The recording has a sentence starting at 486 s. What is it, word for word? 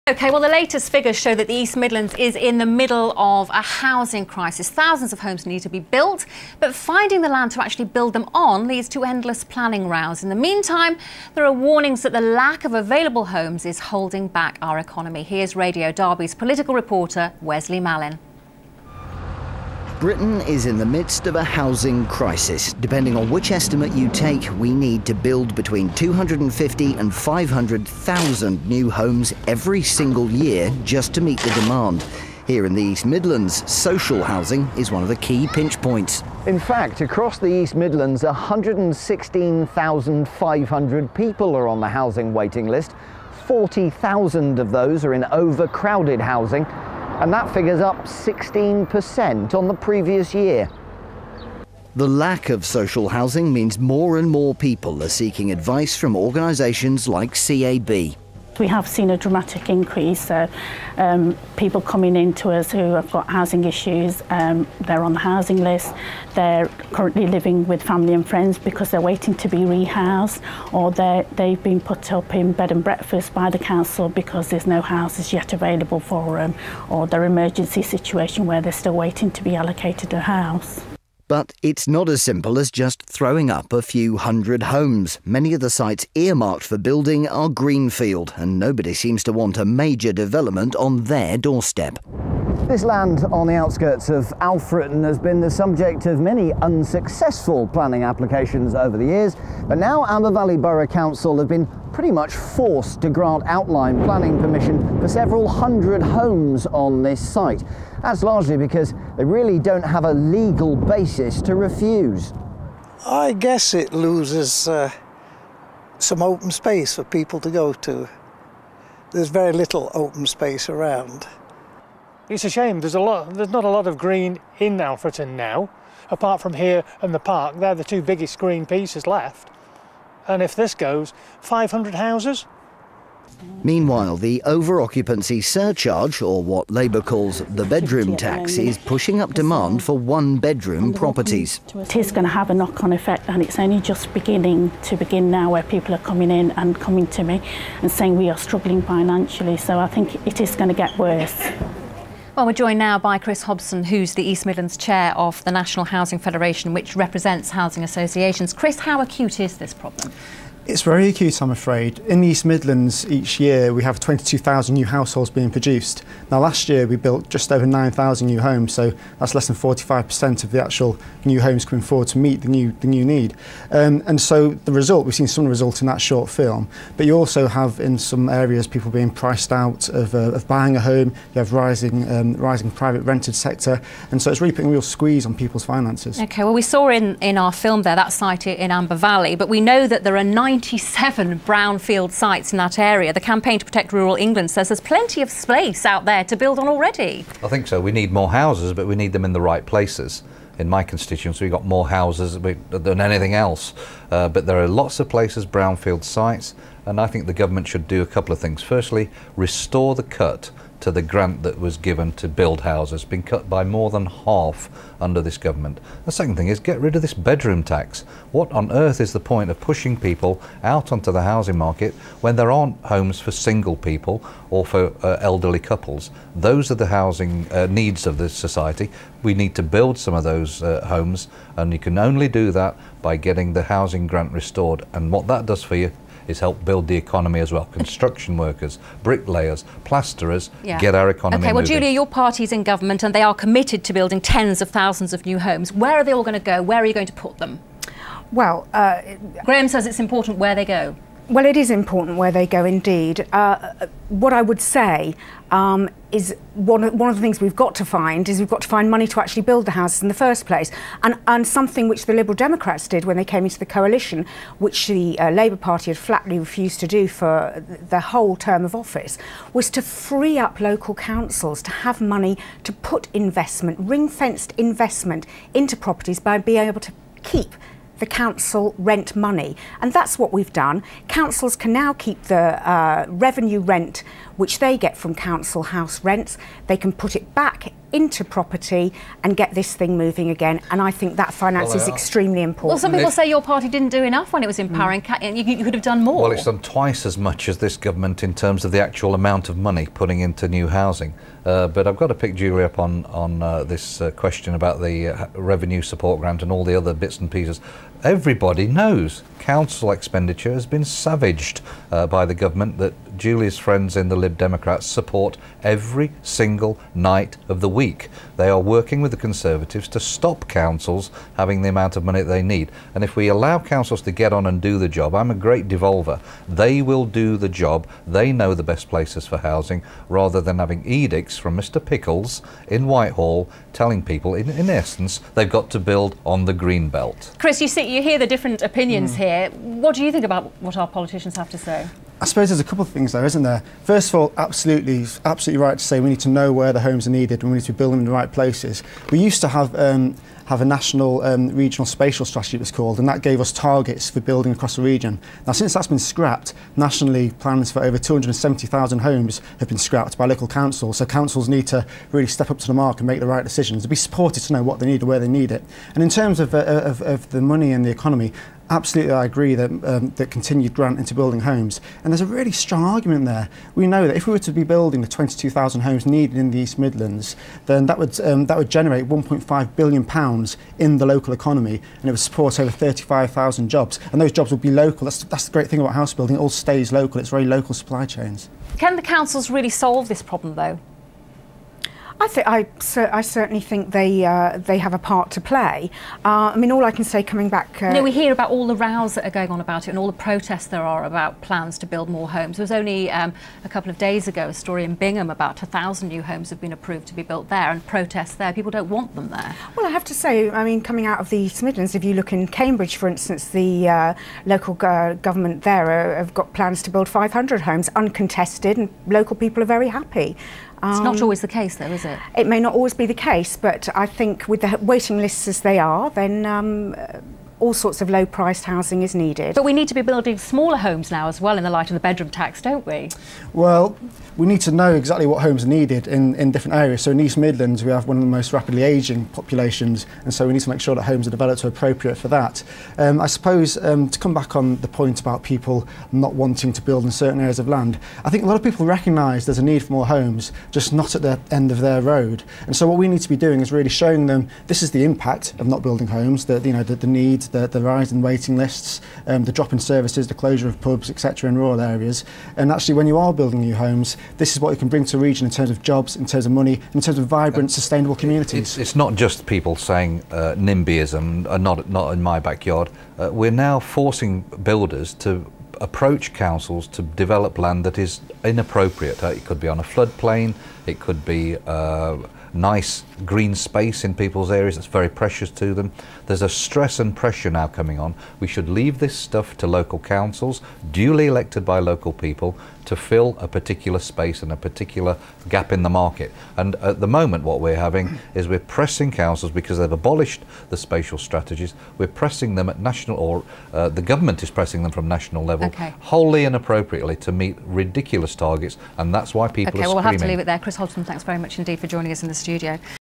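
There's a stress and pressure now coming on.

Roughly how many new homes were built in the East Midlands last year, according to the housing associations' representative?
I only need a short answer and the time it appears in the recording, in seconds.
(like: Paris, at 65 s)
just over 9,000, at 167 s.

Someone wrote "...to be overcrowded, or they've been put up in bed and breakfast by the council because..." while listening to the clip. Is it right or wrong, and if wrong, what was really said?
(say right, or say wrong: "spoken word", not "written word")
wrong: "rehoused", not "overcrowded".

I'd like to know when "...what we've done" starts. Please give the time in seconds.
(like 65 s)
280 s.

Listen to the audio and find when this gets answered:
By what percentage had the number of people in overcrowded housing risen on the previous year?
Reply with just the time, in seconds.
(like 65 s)
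48 s.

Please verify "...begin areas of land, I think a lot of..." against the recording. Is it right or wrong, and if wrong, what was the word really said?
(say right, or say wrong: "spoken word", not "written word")
wrong: "certain", not "begin".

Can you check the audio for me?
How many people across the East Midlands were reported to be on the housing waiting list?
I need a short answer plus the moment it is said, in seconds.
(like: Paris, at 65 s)
116,500, at 38 s.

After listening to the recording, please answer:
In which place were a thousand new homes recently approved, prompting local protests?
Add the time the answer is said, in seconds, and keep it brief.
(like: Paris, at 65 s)
Bingham, at 404 s.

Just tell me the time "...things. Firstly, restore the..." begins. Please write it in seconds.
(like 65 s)
208 s.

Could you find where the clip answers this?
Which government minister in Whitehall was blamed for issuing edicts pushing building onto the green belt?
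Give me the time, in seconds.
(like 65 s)
331 s.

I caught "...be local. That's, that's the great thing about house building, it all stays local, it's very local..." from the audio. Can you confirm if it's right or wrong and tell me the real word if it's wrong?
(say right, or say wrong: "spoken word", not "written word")
right.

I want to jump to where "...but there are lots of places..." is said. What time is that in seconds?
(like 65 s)
204 s.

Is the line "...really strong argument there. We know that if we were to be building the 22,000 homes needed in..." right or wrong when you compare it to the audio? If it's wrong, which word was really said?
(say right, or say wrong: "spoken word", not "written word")
right.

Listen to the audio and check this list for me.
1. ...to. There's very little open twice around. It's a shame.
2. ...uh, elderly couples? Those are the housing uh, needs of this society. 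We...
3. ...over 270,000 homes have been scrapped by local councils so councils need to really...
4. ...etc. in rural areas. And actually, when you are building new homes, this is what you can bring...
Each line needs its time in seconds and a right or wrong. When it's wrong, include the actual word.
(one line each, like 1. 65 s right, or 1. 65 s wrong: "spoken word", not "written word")
1. 117 s wrong: "space", not "twice"
2. 225 s right
3. 357 s right
4. 461 s right.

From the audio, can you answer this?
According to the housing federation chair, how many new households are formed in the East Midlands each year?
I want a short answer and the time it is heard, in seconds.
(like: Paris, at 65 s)
22,000, at 163 s.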